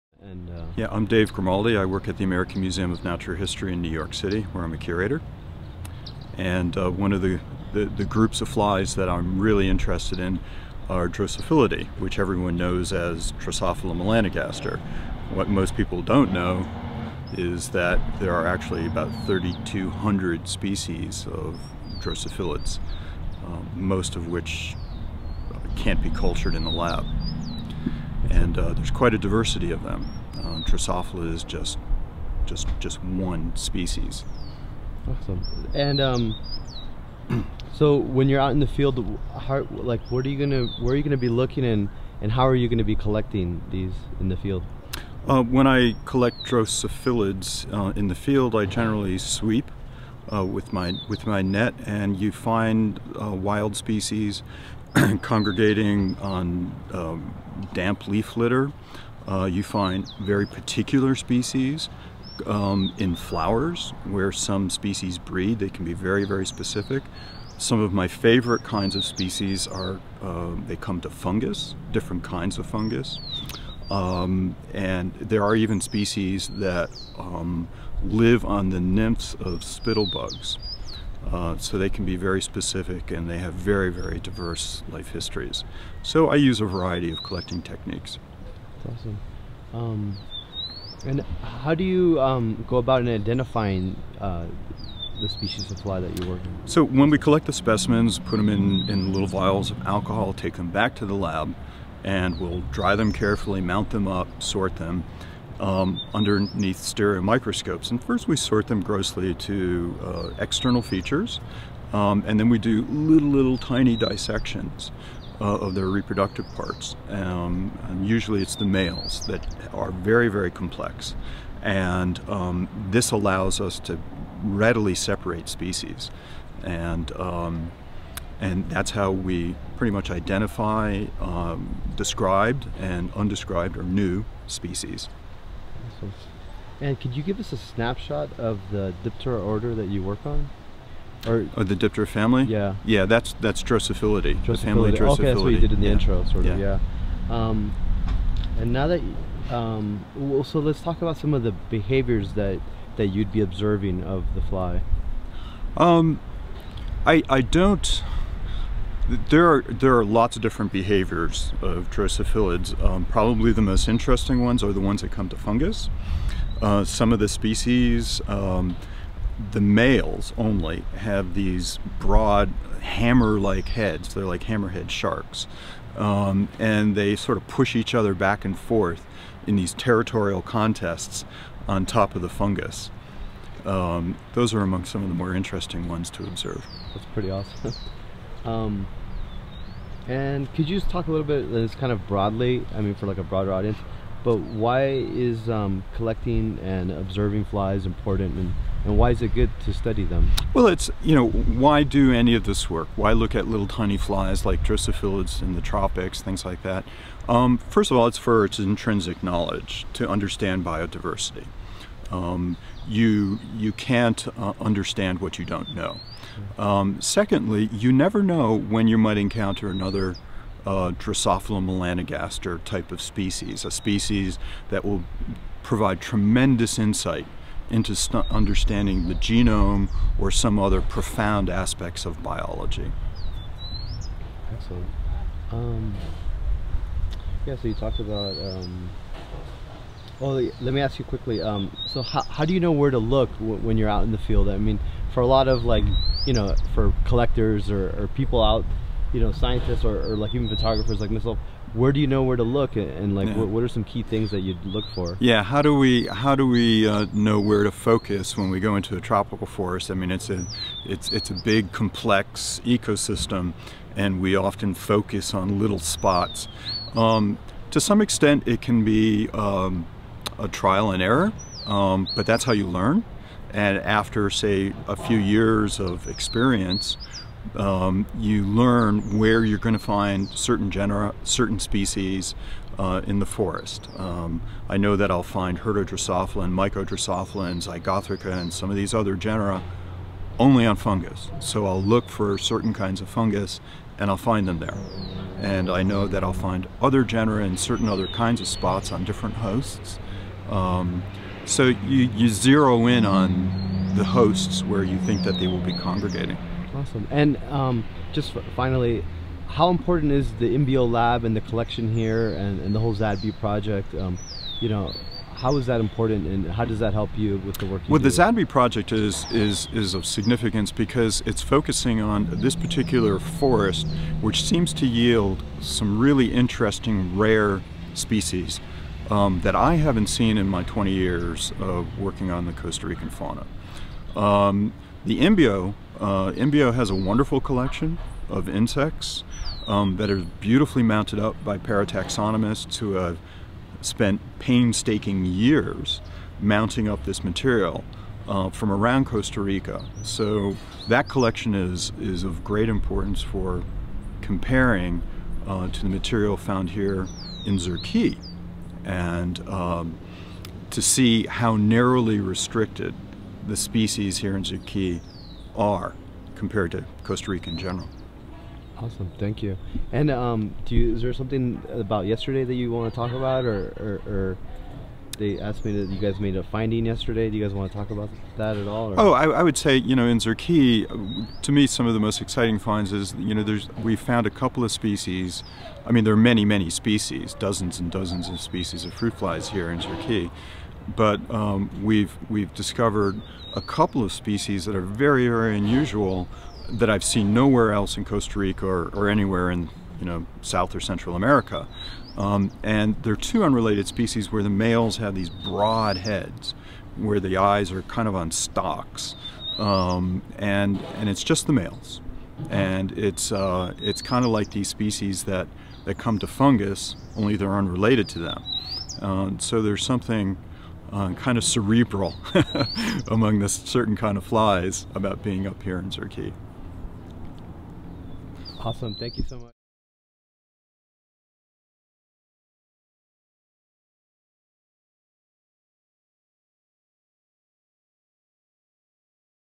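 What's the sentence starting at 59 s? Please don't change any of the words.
Uh, you find very particular species um, in flowers where some species breed.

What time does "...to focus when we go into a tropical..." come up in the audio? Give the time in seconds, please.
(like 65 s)
257 s.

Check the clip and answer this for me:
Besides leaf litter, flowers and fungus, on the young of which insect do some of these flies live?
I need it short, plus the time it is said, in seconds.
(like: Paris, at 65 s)
spittlebugs, at 79 s.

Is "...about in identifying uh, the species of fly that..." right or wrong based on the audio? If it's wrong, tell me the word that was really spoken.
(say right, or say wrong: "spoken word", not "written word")
right.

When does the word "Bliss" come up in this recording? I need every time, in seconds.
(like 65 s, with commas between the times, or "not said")
not said.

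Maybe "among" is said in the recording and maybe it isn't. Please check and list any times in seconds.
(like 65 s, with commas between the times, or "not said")
184 s, 423 s.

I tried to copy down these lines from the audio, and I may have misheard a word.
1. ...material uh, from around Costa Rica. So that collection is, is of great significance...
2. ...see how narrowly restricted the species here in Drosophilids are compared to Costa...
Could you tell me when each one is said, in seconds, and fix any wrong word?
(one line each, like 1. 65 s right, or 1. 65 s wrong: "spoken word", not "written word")
1. 347 s wrong: "importance", not "significance"
2. 360 s wrong: "Zurqui", not "Drosophilids".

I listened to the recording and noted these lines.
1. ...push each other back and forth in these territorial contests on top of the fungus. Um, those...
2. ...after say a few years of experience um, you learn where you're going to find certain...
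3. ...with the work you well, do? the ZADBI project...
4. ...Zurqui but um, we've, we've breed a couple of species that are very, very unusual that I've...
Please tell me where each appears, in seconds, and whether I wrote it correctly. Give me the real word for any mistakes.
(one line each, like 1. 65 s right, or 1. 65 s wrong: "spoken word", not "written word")
1. 177 s right
2. 273 s right
3. 317 s right
4. 389 s wrong: "discovered", not "breed".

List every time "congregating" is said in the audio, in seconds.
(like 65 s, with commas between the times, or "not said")
55 s, 305 s.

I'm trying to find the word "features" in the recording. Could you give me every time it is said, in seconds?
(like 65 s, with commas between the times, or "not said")
110 s.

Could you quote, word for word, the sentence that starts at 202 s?
Why look at little tiny flies like Drosophilids in the tropics, things like that?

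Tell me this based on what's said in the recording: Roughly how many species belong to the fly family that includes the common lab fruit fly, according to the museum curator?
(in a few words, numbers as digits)
3,200.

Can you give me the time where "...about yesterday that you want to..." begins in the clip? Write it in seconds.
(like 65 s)
371 s.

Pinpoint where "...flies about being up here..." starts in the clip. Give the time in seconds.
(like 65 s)
424 s.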